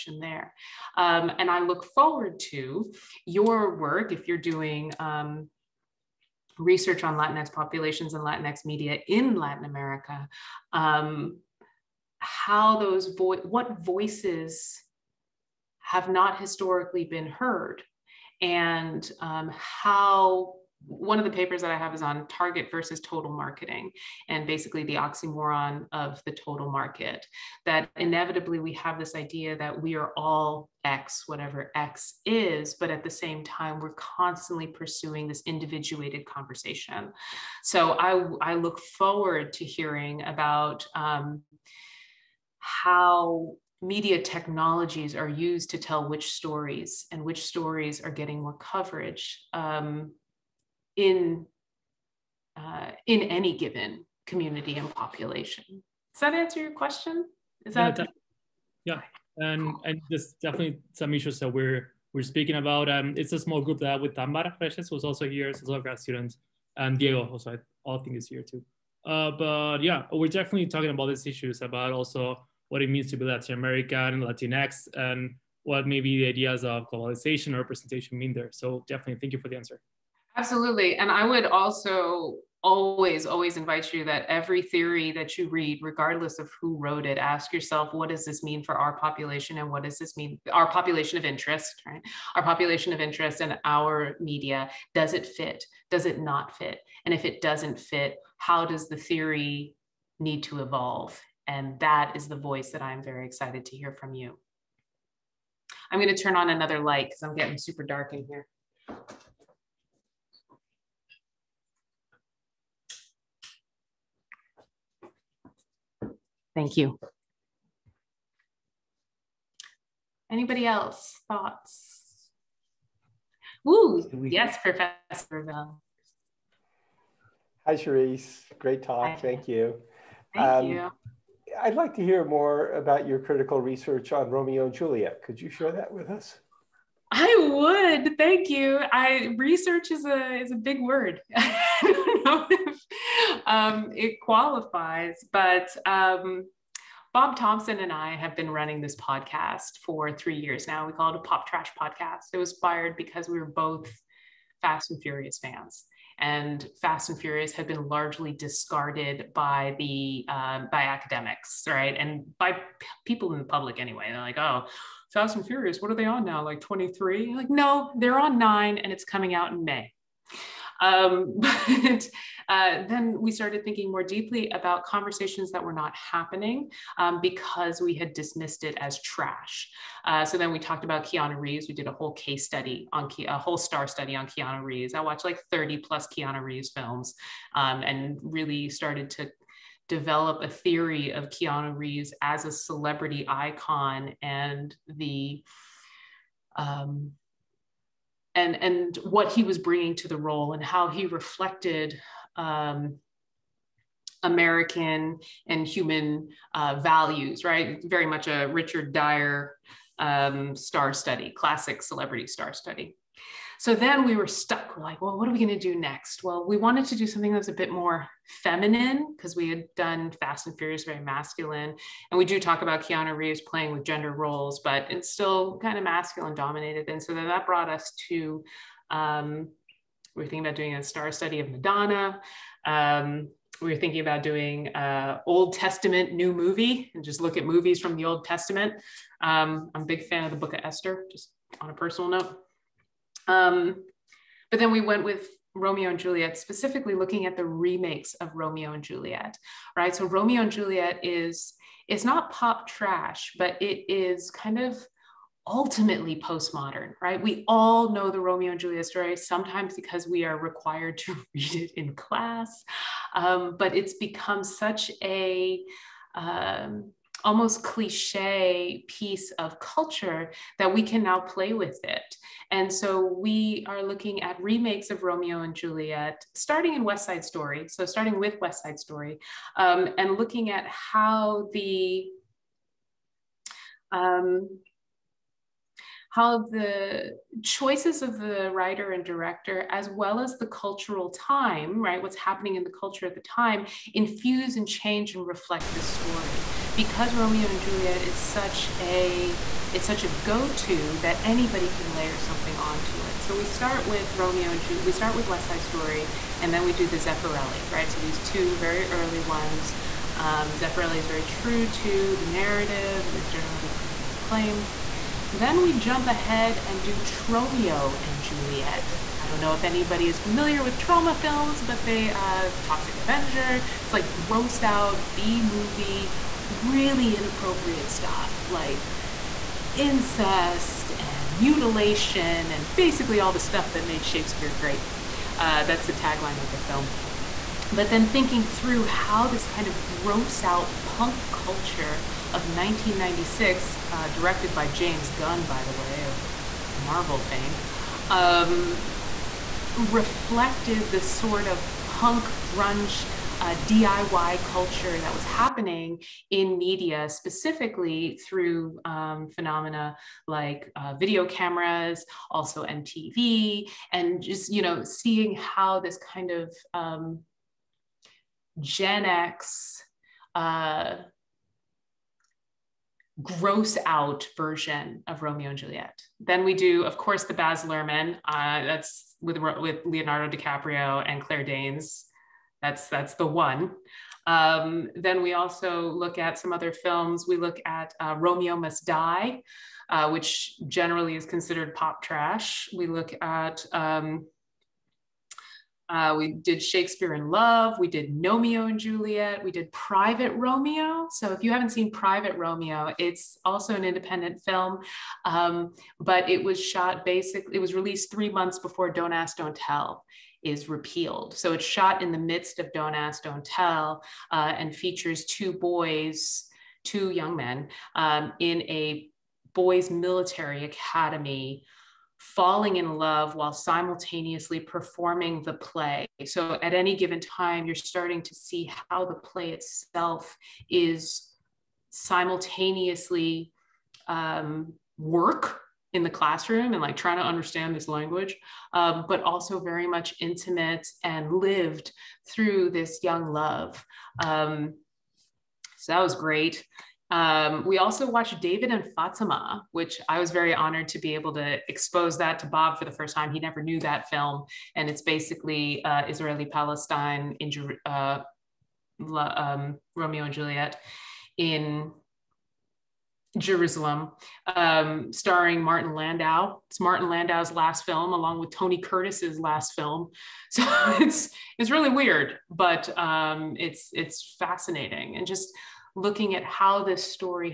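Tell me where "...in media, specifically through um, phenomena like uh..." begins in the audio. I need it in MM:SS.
05:56.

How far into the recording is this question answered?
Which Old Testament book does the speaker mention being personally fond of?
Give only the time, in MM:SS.
04:00.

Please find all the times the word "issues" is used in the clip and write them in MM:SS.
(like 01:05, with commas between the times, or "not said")
01:01, 01:11.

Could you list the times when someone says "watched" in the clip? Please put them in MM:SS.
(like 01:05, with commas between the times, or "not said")
03:05, 07:28.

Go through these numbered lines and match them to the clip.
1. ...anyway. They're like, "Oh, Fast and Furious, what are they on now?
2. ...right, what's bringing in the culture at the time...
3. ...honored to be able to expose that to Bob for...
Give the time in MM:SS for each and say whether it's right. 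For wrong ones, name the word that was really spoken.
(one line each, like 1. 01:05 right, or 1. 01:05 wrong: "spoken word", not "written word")
1. 02:43 right
2. 04:51 wrong: "happening", not "bringing"
3. 07:30 right.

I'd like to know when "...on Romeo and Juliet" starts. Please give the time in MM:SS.
02:14.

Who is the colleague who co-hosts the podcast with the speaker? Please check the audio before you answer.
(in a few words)
Bob Thompson.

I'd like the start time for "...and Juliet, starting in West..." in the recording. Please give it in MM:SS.
04:35.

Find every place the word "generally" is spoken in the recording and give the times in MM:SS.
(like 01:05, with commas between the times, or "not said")
05:13, 06:30.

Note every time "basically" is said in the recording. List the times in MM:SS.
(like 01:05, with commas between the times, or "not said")
00:24, 05:32, 06:47, 07:35.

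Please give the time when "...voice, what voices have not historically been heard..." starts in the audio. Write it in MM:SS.
00:13.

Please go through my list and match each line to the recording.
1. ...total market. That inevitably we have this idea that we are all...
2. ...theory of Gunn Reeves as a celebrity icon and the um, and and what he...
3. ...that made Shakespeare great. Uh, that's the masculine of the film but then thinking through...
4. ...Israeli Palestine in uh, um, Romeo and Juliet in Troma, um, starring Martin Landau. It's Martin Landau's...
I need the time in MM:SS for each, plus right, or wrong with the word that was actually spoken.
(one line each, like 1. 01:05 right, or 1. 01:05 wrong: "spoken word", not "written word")
1. 00:26 right
2. 03:10 wrong: "Keanu", not "Gunn"
3. 05:33 wrong: "tagline", not "masculine"
4. 07:36 wrong: "Jerusalem", not "Troma".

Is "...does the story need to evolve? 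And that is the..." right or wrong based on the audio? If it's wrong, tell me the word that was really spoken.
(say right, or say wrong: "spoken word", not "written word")
wrong: "theory", not "story".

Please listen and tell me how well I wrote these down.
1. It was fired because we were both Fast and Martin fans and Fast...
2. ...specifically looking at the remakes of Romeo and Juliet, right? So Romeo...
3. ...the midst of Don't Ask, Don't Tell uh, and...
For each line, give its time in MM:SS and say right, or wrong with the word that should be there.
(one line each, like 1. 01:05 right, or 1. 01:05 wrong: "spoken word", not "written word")
1. 02:32 wrong: "Furious", not "Martin"
2. 04:06 right
3. 06:52 right.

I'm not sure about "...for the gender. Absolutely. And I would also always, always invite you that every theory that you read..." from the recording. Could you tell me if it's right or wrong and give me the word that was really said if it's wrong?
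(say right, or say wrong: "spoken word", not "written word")
wrong: "answer", not "gender".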